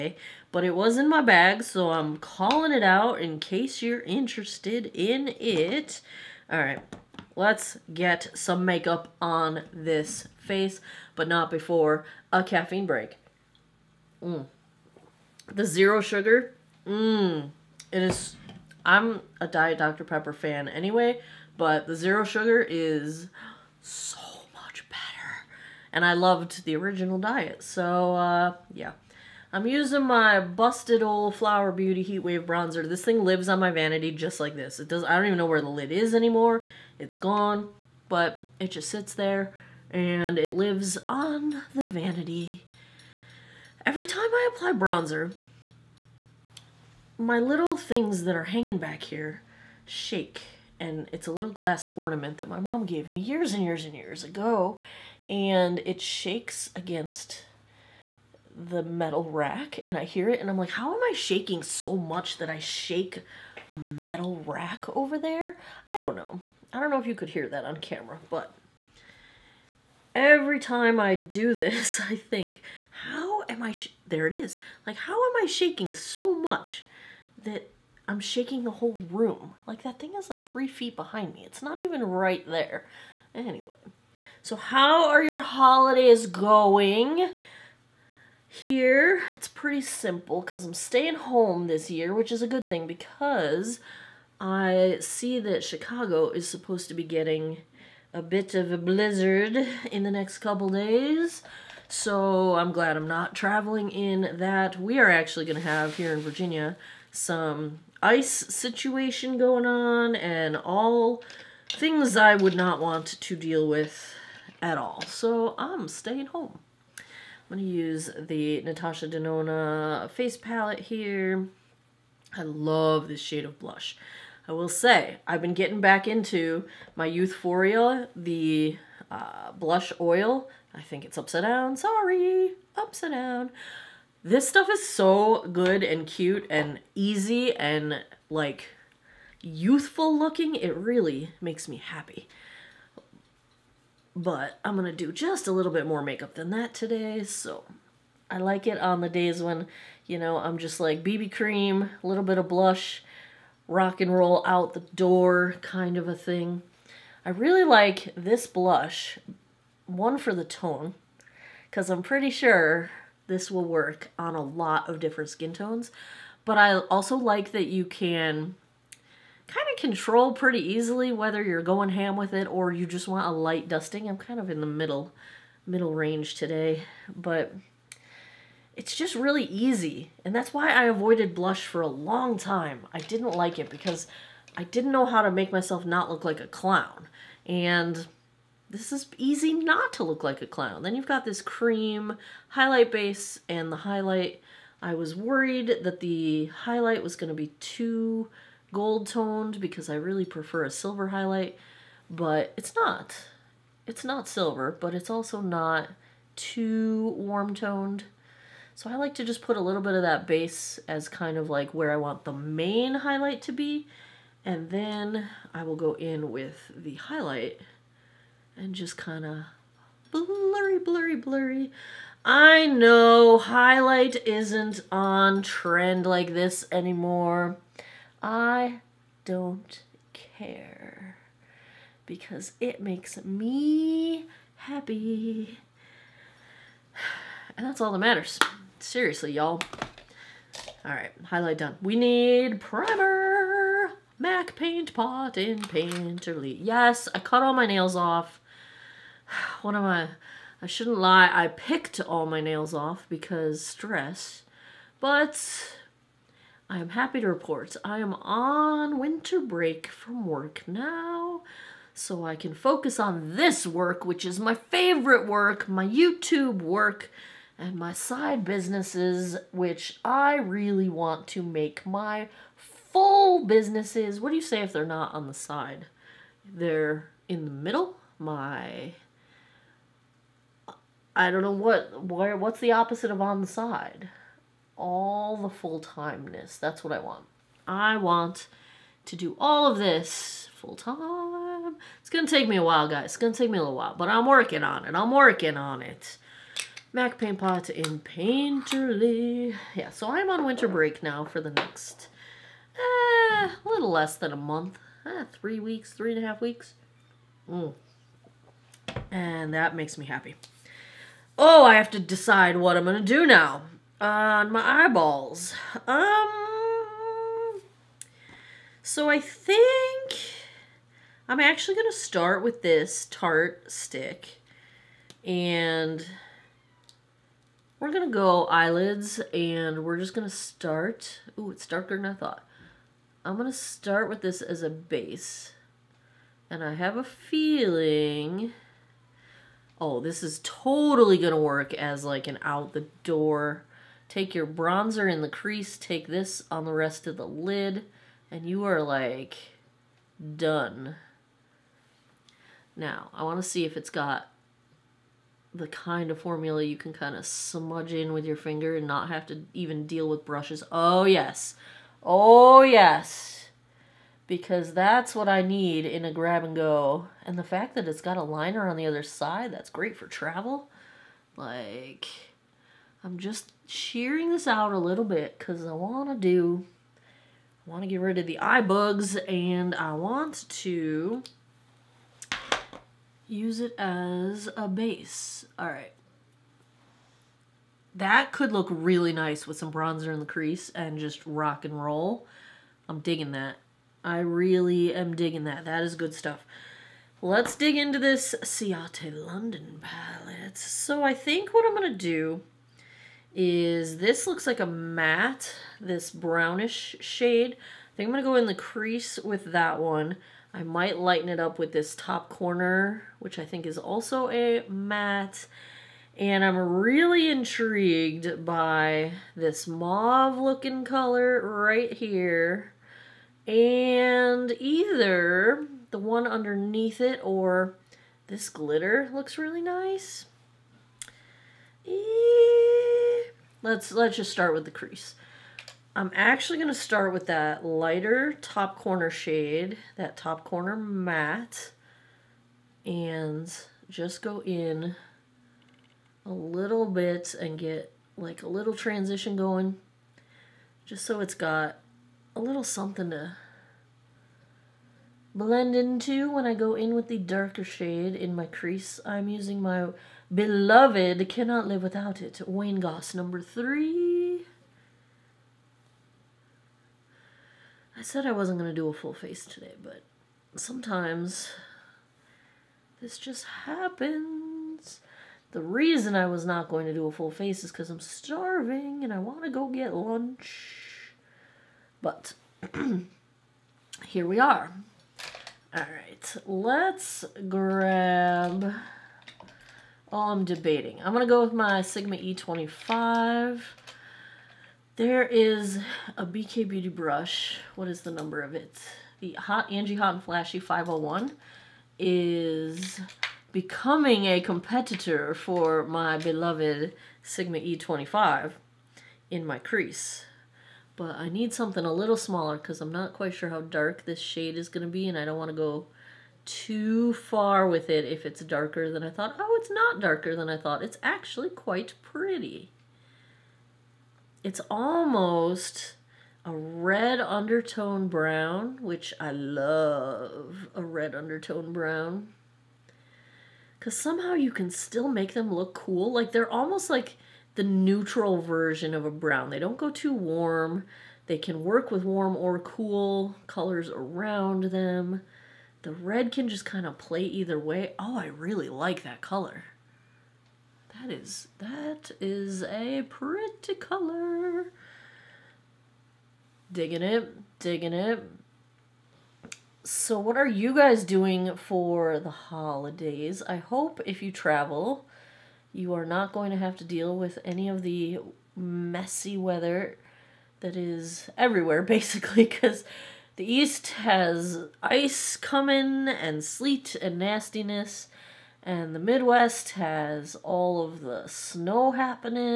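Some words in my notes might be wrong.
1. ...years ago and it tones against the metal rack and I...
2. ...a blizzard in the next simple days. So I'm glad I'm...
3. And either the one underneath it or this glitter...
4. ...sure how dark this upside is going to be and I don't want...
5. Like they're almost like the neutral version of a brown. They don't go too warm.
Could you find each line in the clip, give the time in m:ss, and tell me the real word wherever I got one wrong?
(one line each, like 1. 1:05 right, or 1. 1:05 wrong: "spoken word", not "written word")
1. 0:53 wrong: "shakes", not "tones"
2. 1:38 wrong: "couple", not "simple"
3. 7:03 right
4. 8:33 wrong: "shade", not "upside"
5. 8:56 right.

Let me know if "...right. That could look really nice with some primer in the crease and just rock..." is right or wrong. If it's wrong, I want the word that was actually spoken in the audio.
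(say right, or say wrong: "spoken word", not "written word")
wrong: "bronzer", not "primer".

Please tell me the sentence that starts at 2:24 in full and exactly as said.
But I'm going to do just a little bit more makeup than that today.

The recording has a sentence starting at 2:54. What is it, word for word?
I'm kind of in the middle, middle range today, but it's just really easy.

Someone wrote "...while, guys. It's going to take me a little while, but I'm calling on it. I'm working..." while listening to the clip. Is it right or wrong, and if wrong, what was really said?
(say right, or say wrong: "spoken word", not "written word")
wrong: "working", not "calling".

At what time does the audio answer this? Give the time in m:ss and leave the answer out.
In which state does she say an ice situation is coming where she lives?
1:46.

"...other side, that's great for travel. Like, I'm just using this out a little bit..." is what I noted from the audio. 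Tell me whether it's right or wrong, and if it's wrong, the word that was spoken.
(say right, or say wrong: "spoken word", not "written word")
wrong: "shearing", not "using".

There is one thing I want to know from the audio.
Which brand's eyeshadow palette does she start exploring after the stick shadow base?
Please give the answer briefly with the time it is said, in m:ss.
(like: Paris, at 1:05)
Ciate London, at 6:38.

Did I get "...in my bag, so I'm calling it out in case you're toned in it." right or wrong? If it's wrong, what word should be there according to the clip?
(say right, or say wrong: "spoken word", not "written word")
wrong: "interested", not "toned".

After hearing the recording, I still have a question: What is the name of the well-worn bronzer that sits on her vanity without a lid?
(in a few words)
Flower Beauty Heatwave Bronzer.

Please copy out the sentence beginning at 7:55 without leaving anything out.
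The reason I was not going to do a full face is because I'm starving and I want to go get lunch.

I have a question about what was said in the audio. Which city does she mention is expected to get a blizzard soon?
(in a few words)
Chicago.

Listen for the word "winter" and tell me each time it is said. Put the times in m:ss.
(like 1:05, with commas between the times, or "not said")
4:18, 5:00.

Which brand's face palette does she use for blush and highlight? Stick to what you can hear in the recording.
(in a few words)
Natasha Denona.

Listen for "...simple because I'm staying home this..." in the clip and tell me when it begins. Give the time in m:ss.
1:29.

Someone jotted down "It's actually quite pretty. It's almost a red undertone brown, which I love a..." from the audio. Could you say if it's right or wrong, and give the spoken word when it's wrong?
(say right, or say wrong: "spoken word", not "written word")
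right.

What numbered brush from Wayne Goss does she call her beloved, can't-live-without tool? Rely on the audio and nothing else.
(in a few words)
3.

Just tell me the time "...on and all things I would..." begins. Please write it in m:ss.
1:49.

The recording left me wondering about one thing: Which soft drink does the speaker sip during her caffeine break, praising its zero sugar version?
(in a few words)
Dr. Pepper.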